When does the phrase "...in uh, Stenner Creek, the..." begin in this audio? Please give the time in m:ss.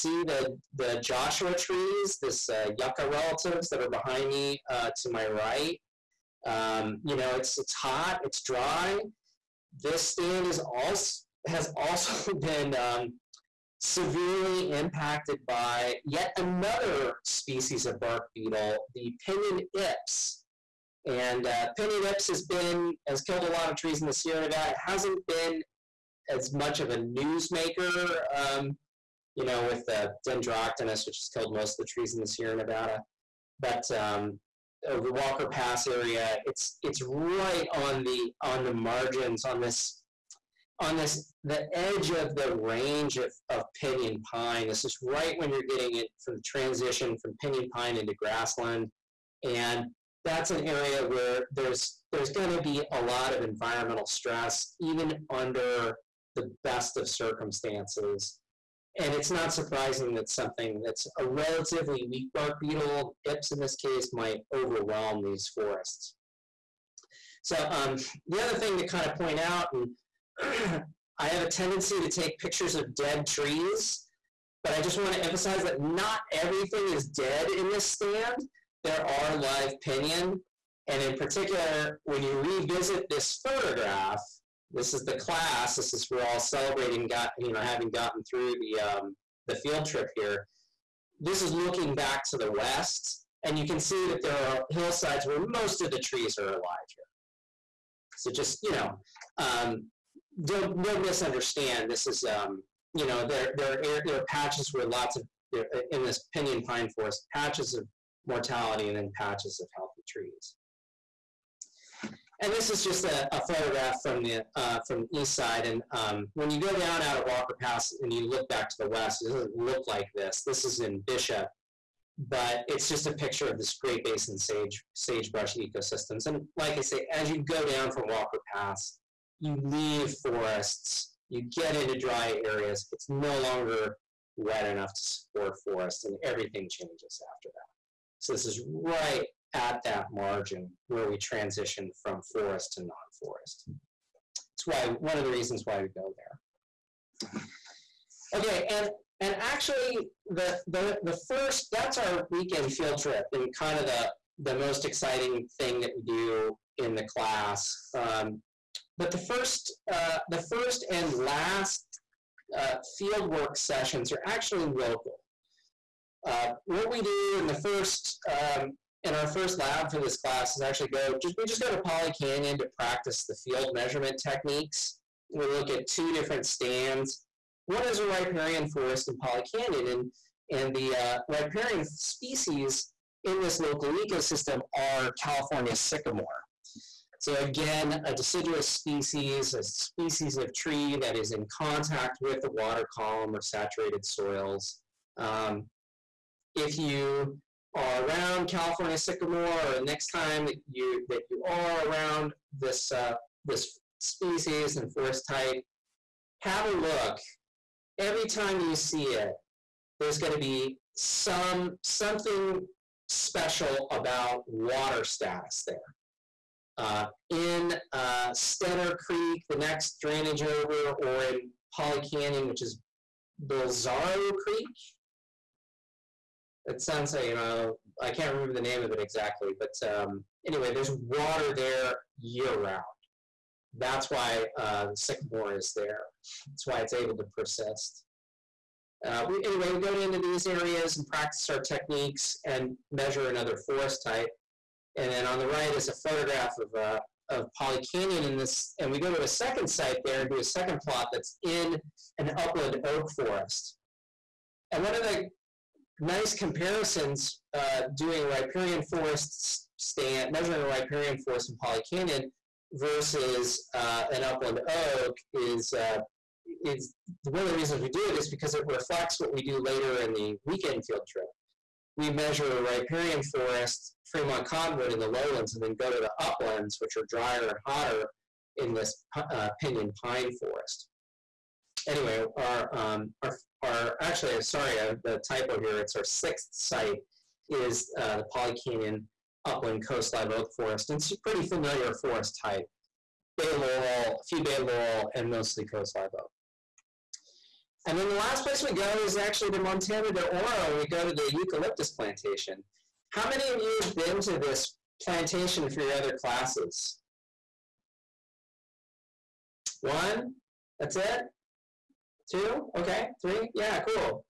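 3:37.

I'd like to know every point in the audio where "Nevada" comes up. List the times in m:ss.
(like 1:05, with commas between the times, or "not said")
0:24, 0:32.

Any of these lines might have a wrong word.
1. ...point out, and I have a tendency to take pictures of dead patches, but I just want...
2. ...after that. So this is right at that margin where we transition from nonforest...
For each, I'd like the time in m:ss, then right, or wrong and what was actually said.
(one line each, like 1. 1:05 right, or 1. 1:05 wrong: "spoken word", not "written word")
1. 1:09 wrong: "trees", not "patches"
2. 2:17 wrong: "forest", not "nonforest".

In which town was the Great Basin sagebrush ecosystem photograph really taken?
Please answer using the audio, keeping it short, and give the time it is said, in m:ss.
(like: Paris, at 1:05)
Bishop, at 2:01.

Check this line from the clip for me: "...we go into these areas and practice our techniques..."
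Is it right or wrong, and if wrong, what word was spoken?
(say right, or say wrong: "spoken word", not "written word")
right.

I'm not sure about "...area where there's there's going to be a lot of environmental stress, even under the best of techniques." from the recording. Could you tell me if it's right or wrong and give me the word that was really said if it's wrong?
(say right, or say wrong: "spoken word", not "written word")
wrong: "circumstances", not "techniques".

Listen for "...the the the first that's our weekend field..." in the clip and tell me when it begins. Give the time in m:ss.
2:30.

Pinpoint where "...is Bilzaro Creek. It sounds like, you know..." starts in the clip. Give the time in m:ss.
3:42.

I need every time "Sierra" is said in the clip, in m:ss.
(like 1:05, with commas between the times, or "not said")
0:24, 0:32.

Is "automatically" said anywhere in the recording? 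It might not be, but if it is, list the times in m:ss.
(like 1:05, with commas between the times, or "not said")
not said.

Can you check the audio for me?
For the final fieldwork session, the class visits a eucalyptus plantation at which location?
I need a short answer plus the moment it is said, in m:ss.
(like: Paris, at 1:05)
Montana de Oro, at 4:59.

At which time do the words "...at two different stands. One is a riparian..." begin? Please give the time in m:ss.
2:55.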